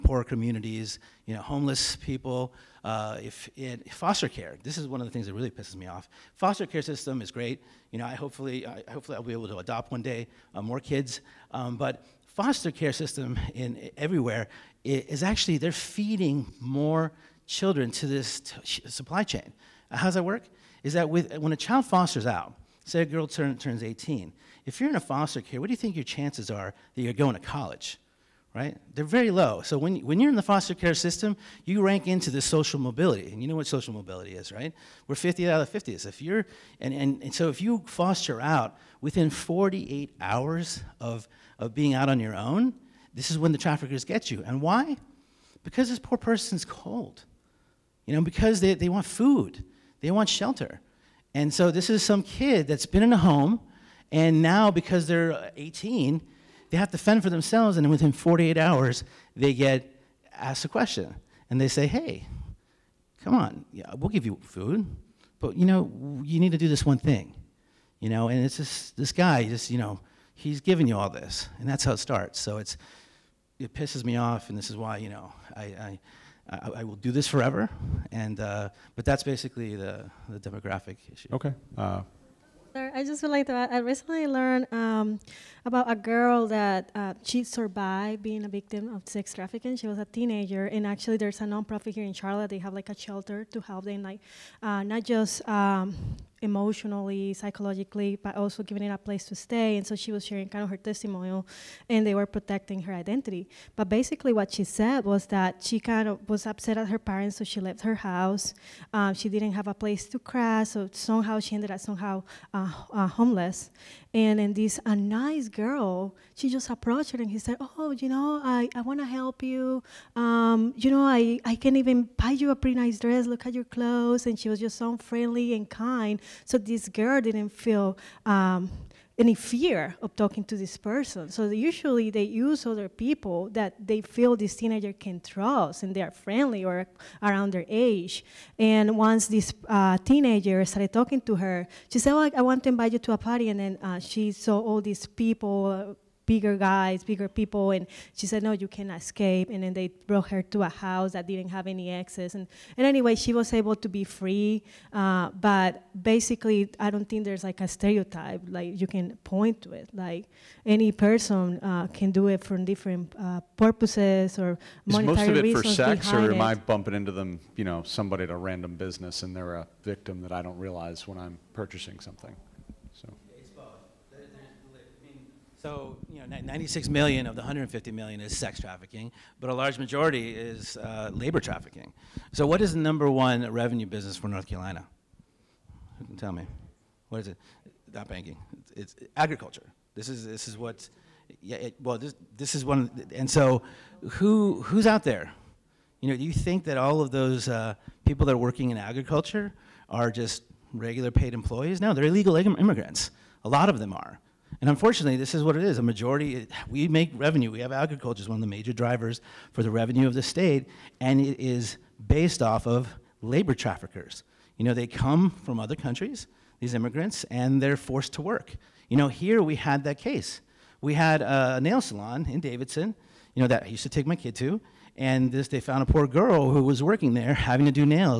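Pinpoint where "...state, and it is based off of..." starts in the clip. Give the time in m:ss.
3:30.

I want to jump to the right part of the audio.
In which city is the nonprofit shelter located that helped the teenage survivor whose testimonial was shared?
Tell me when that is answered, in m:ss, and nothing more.
1:32.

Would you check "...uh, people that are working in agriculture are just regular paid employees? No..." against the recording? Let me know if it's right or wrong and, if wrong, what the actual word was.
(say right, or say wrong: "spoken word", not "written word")
right.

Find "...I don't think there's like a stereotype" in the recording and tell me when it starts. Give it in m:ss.
2:36.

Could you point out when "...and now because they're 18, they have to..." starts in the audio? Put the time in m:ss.
0:54.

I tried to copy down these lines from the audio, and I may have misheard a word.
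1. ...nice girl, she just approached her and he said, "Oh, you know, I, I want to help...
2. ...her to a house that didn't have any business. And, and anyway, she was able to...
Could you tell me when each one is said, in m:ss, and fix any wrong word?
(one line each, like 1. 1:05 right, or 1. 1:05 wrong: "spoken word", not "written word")
1. 1:54 right
2. 2:30 wrong: "access", not "business".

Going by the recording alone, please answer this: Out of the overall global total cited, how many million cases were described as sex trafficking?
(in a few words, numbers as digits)
96 million.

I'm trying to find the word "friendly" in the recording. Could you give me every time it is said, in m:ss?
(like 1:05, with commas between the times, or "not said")
2:04, 2:16.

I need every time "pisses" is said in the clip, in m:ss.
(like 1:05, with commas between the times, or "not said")
0:05, 1:13.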